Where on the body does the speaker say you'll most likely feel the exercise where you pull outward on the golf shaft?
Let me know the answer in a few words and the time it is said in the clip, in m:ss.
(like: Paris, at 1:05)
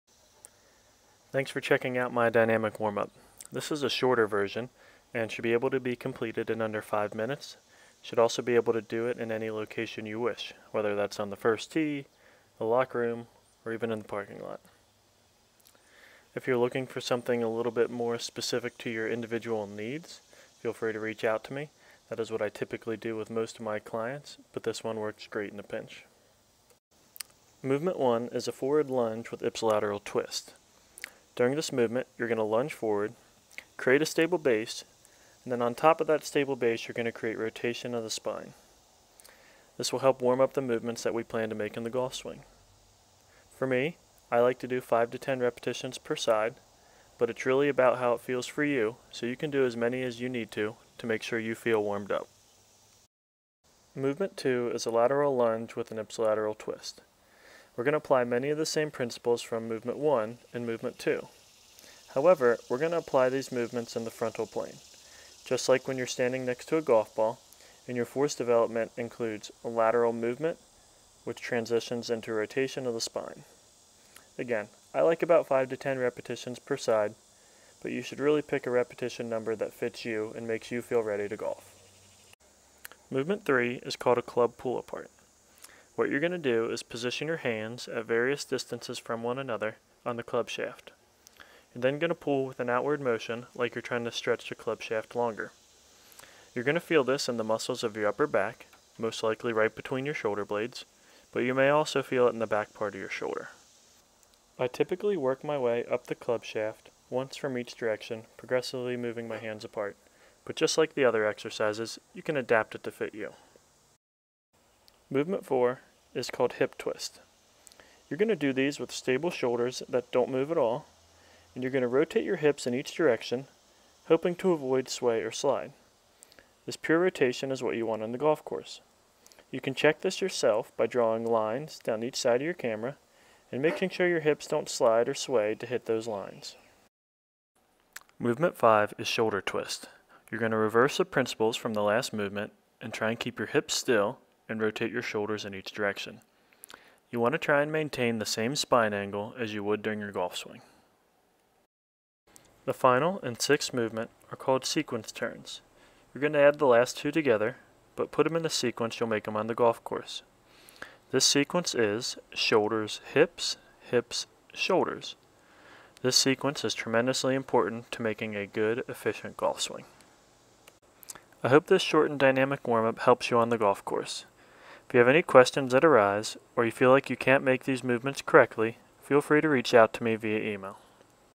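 between your shoulder blades, at 1:39.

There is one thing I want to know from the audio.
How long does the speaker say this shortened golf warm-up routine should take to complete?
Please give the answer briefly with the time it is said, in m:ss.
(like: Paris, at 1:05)
under 5 minutes, at 0:06.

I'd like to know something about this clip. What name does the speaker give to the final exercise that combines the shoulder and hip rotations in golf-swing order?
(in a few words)
sequence turns.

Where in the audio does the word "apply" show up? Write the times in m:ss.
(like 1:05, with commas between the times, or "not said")
0:57, 1:02.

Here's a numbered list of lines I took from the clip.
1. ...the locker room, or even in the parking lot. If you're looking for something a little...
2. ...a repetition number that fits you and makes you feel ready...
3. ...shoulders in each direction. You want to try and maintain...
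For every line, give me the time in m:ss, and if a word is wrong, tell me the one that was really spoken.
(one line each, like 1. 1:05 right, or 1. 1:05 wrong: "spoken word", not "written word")
1. 0:12 right
2. 1:18 right
3. 2:25 right.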